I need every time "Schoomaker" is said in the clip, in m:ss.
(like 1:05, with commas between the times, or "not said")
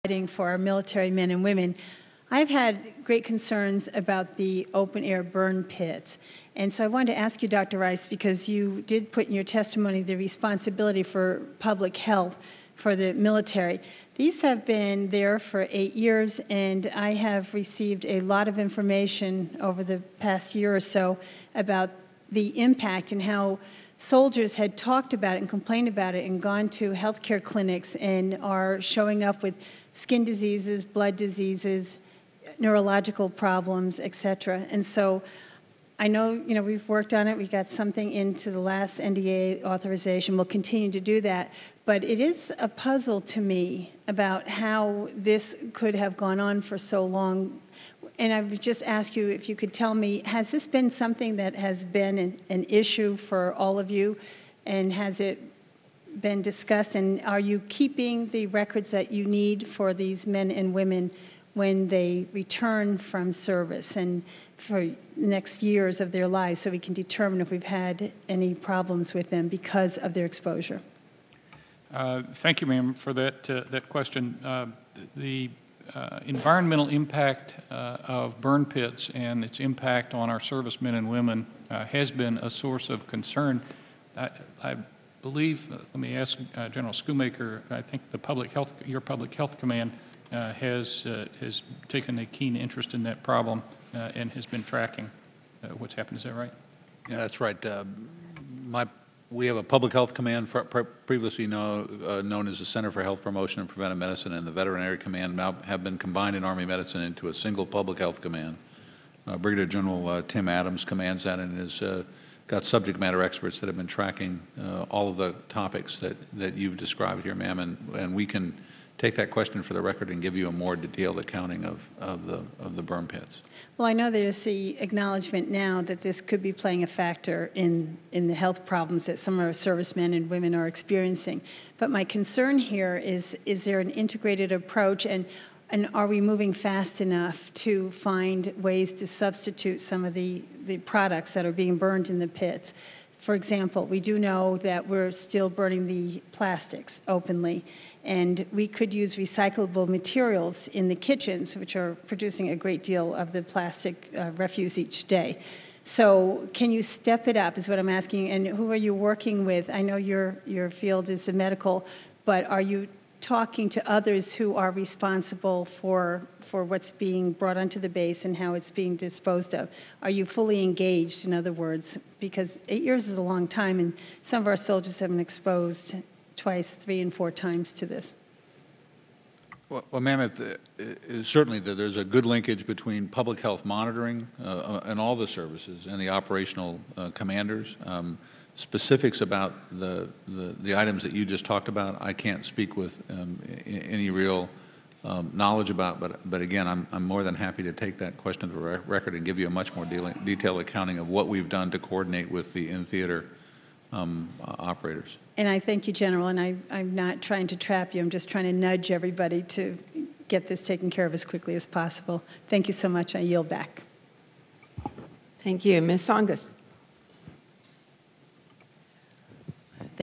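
1:26.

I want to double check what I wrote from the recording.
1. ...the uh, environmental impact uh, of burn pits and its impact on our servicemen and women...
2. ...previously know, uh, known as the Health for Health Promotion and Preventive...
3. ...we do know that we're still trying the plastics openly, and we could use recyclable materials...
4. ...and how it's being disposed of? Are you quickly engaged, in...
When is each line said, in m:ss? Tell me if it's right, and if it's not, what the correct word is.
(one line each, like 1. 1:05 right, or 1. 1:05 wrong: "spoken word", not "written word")
1. 1:15 right
2. 1:41 wrong: "Center", not "Health"
3. 2:23 wrong: "burning", not "trying"
4. 2:48 wrong: "fully", not "quickly".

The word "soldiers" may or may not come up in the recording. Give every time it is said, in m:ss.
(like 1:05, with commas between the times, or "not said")
0:23, 2:54.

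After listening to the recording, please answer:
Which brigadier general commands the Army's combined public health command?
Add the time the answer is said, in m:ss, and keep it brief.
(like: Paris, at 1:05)
Tim Adams, at 1:50.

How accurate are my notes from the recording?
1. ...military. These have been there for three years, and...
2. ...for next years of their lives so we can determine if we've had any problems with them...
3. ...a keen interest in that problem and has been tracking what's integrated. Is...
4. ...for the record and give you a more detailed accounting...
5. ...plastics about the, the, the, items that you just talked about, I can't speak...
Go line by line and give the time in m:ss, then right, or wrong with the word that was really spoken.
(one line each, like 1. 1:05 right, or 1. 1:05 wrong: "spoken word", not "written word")
1. 0:13 wrong: "eight", not "three"
2. 1:04 right
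3. 1:32 wrong: "happened", not "integrated"
4. 1:59 right
5. 3:08 wrong: "specifics", not "plastics".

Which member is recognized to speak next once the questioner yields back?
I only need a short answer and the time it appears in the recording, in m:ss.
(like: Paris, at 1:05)
Ms. Tsongas, at 3:35.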